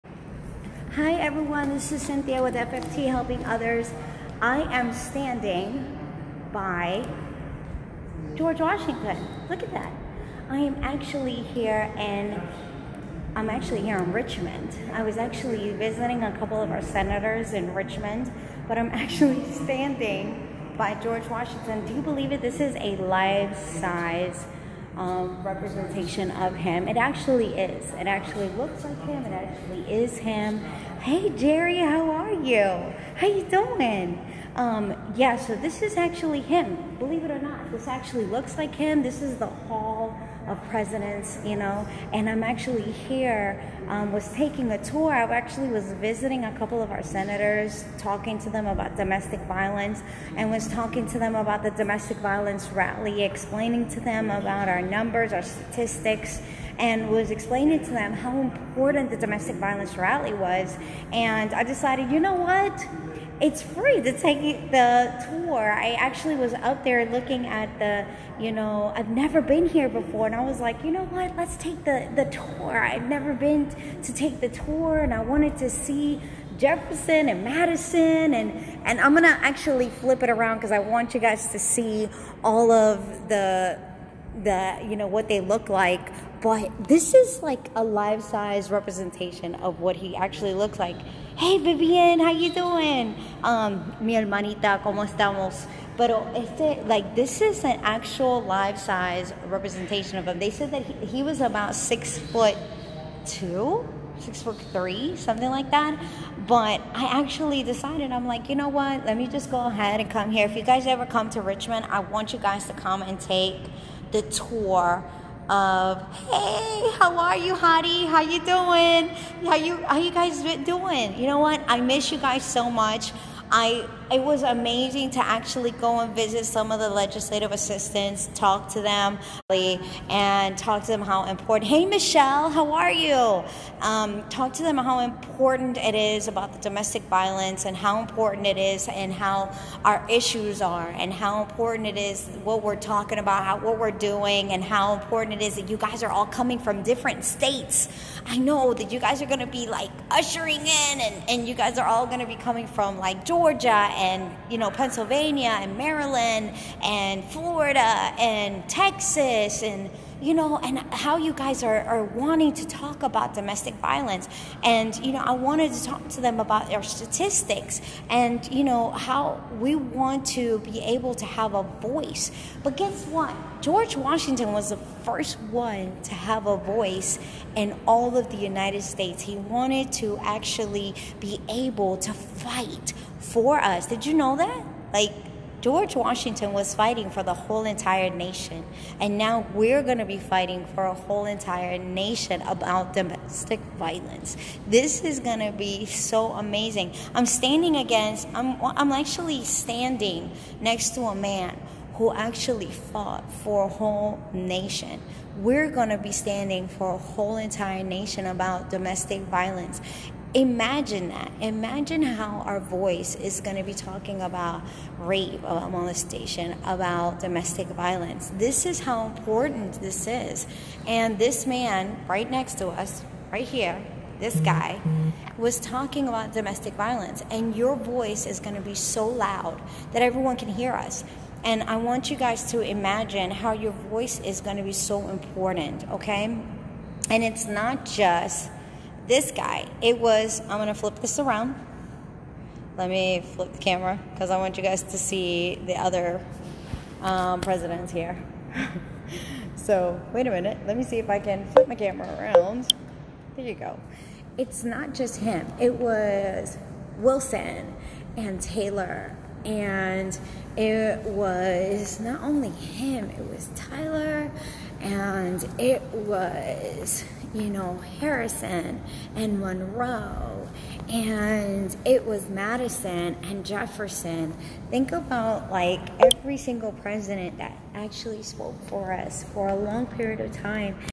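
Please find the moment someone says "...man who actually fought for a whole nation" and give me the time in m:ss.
3:21.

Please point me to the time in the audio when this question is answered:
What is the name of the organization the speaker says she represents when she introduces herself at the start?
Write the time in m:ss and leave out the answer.
0:02.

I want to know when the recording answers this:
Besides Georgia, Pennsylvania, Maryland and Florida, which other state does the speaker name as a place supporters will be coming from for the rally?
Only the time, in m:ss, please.
2:38.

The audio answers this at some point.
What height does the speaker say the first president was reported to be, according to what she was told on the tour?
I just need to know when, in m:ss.
1:41.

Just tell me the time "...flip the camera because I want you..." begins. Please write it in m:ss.
4:03.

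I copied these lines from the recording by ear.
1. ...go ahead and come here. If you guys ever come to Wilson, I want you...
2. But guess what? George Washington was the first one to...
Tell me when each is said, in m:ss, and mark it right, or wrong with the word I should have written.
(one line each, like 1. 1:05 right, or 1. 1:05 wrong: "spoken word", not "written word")
1. 1:49 wrong: "Richmond", not "Wilson"
2. 2:52 right.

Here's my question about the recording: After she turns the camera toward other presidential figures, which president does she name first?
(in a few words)
Wilson.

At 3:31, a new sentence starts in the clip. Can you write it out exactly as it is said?
Imagine how our voice is going to be talking about rape, about molestation, about domestic violence.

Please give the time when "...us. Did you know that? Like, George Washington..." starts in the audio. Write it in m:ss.
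3:03.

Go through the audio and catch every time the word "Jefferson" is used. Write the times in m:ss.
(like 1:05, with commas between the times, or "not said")
1:16, 4:33.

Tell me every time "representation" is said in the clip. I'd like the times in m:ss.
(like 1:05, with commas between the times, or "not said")
0:25, 1:28, 1:39.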